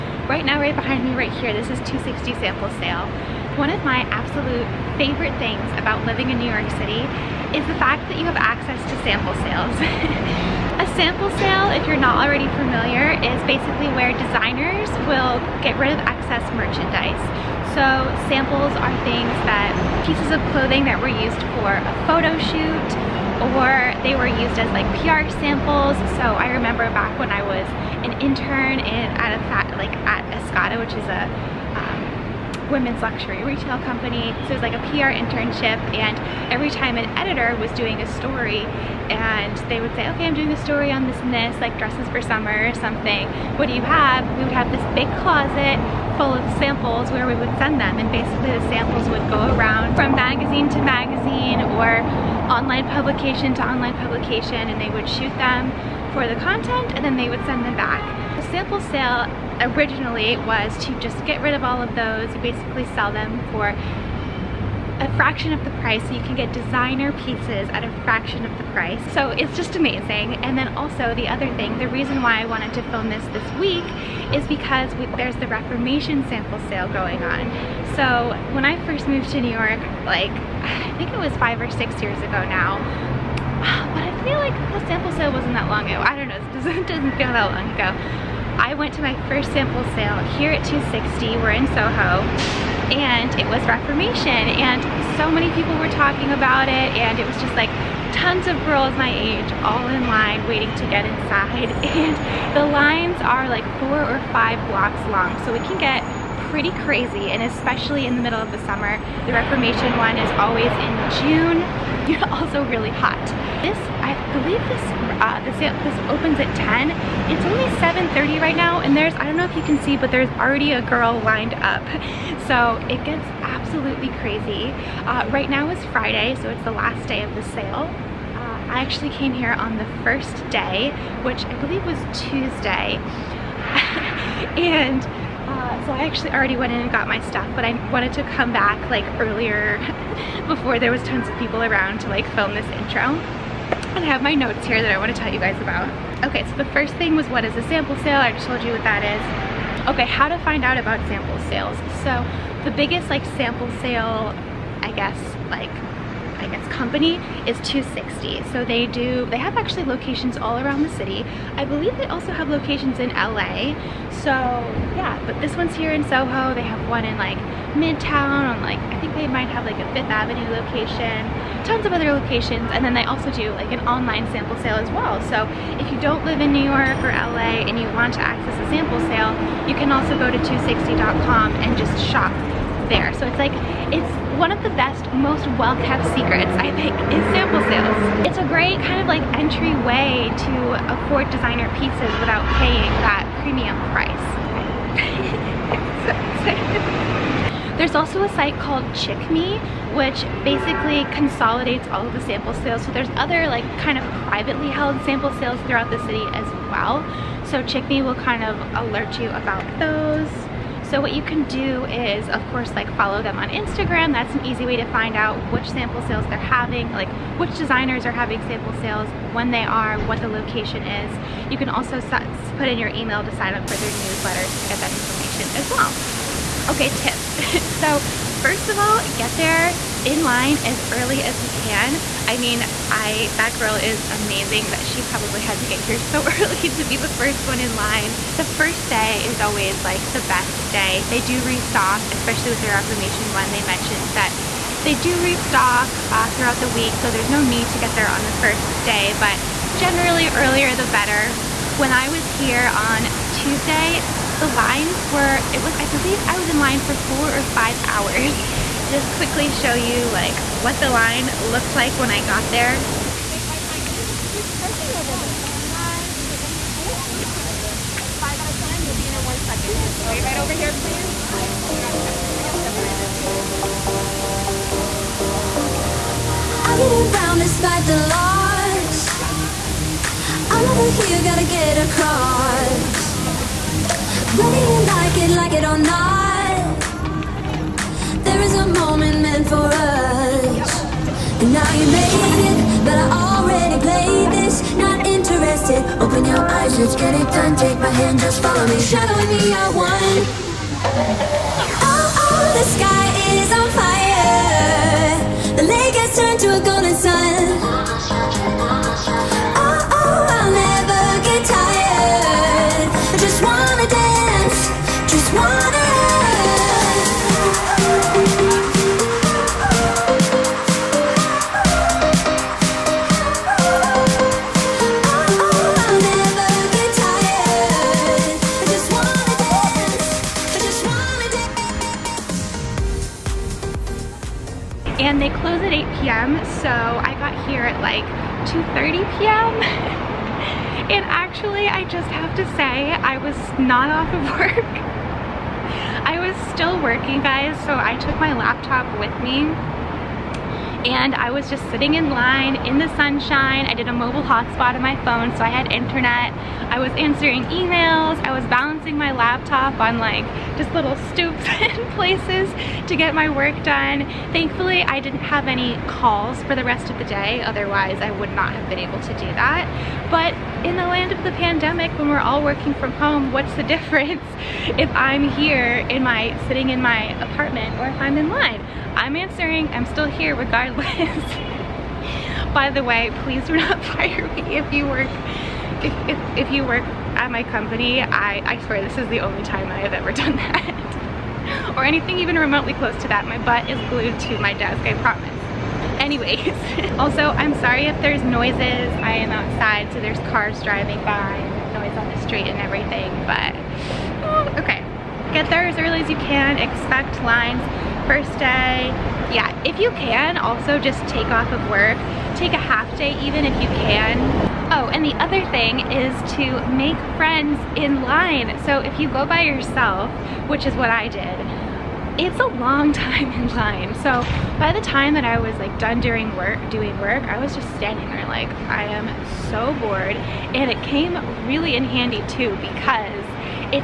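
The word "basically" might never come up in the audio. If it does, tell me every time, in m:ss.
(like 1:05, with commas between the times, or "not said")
0:13, 0:48, 1:02, 3:20.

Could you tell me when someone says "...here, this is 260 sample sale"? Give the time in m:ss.
0:01.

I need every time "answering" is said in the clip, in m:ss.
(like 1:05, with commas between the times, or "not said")
5:56, 6:19.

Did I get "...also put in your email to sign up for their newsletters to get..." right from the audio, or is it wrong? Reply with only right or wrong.
right.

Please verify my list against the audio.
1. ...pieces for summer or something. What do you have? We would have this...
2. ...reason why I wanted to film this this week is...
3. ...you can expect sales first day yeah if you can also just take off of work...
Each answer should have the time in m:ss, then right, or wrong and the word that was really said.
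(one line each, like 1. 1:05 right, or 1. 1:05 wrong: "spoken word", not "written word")
1. 0:41 wrong: "dresses", not "pieces"
2. 1:11 right
3. 6:46 wrong: "lines", not "sales".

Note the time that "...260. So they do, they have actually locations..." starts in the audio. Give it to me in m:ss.
2:37.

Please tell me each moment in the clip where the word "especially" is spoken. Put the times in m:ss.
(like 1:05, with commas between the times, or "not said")
1:47, 4:02.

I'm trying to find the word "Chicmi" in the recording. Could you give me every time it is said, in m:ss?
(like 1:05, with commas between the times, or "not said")
3:18, 3:27.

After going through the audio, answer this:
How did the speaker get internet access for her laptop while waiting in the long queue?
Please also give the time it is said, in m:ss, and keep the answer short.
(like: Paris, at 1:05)
mobile hotspot, at 5:53.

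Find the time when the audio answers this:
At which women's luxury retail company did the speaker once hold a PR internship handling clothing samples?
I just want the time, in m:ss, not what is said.
0:30.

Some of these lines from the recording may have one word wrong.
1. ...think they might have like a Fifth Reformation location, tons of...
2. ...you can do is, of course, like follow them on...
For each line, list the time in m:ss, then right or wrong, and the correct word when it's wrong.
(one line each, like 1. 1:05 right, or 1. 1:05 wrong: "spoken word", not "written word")
1. 2:49 wrong: "Avenue", not "Reformation"
2. 3:31 right.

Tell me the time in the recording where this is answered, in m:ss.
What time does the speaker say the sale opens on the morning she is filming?
1:56.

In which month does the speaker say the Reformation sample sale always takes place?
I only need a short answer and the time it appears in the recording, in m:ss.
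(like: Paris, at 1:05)
June, at 1:51.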